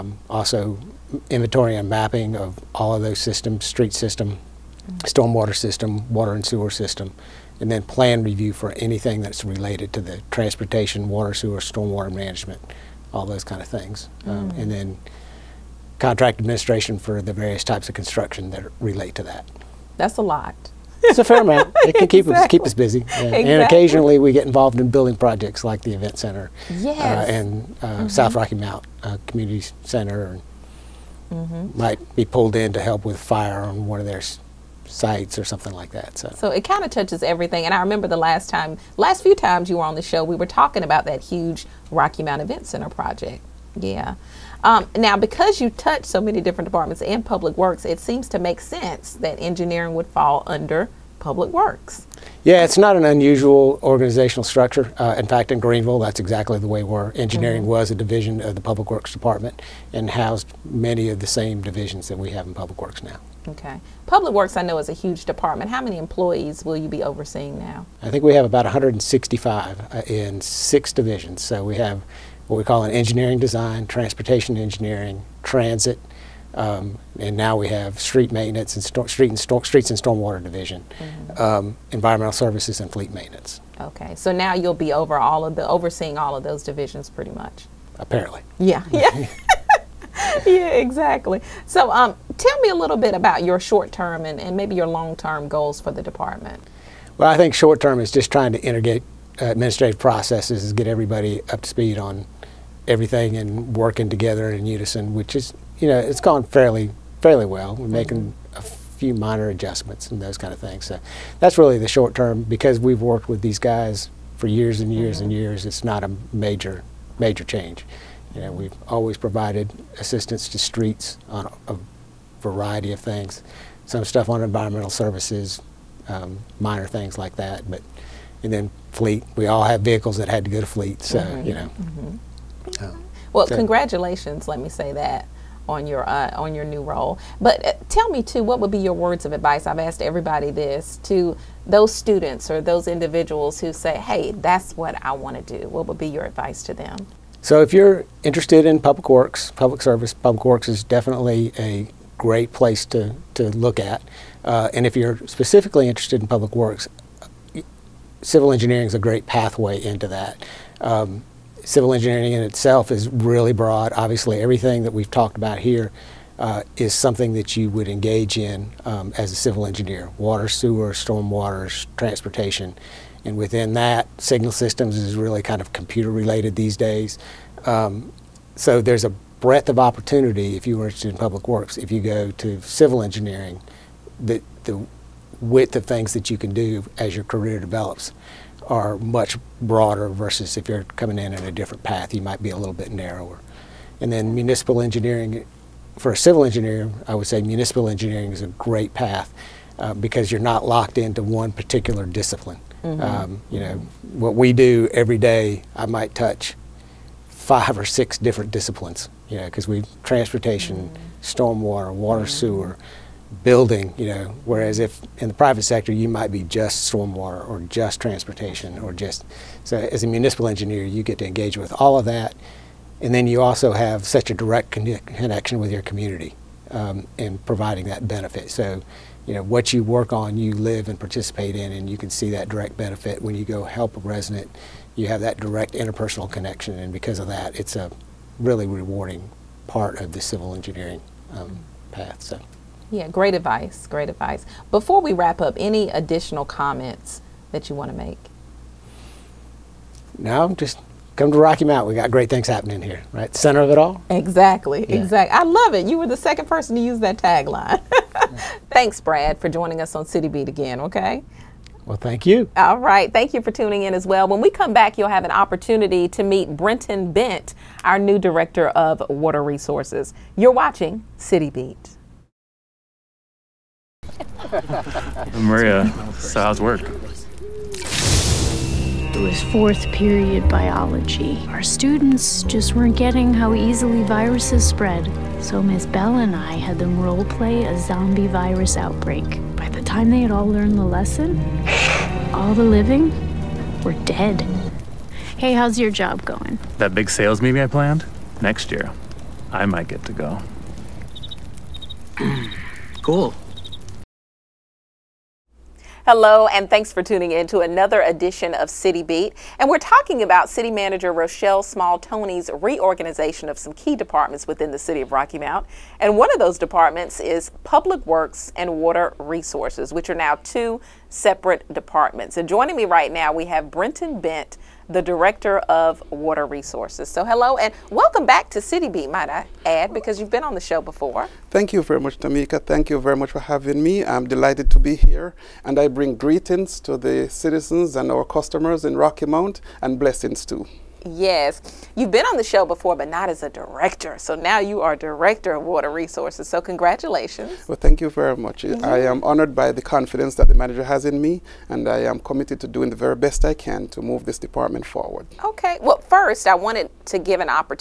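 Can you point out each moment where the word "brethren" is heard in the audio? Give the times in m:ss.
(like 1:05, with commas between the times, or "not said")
not said.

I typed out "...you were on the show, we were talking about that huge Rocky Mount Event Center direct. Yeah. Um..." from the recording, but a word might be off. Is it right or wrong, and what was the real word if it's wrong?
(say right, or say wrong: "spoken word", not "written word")
wrong: "project", not "direct".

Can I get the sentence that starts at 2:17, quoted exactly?
But uh, tell me too, what would be your words of advice?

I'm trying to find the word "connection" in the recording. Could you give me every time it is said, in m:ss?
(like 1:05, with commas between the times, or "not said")
3:45, 3:56.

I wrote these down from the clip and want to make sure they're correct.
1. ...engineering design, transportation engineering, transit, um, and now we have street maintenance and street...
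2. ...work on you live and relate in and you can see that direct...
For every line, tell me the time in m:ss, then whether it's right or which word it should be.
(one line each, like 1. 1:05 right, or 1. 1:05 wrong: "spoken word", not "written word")
1. 1:12 right
2. 3:49 wrong: "participate", not "relate".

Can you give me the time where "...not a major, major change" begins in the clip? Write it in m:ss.
1:55.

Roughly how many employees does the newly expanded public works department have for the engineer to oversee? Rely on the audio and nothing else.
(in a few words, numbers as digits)
165.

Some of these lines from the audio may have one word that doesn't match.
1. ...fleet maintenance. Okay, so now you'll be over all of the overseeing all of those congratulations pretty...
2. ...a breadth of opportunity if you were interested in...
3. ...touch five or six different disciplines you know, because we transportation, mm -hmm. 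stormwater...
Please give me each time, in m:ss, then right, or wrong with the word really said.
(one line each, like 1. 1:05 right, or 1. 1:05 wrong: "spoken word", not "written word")
1. 1:22 wrong: "divisions", not "congratulations"
2. 2:59 right
3. 3:26 right.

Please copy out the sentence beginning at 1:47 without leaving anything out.
making a few minor adjustments and those kind of things.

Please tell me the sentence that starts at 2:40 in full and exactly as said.
Um, civil engineering in itself is really broad.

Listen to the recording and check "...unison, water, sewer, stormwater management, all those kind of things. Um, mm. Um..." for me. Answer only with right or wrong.
wrong.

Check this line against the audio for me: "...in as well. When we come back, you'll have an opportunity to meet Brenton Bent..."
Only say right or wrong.
right.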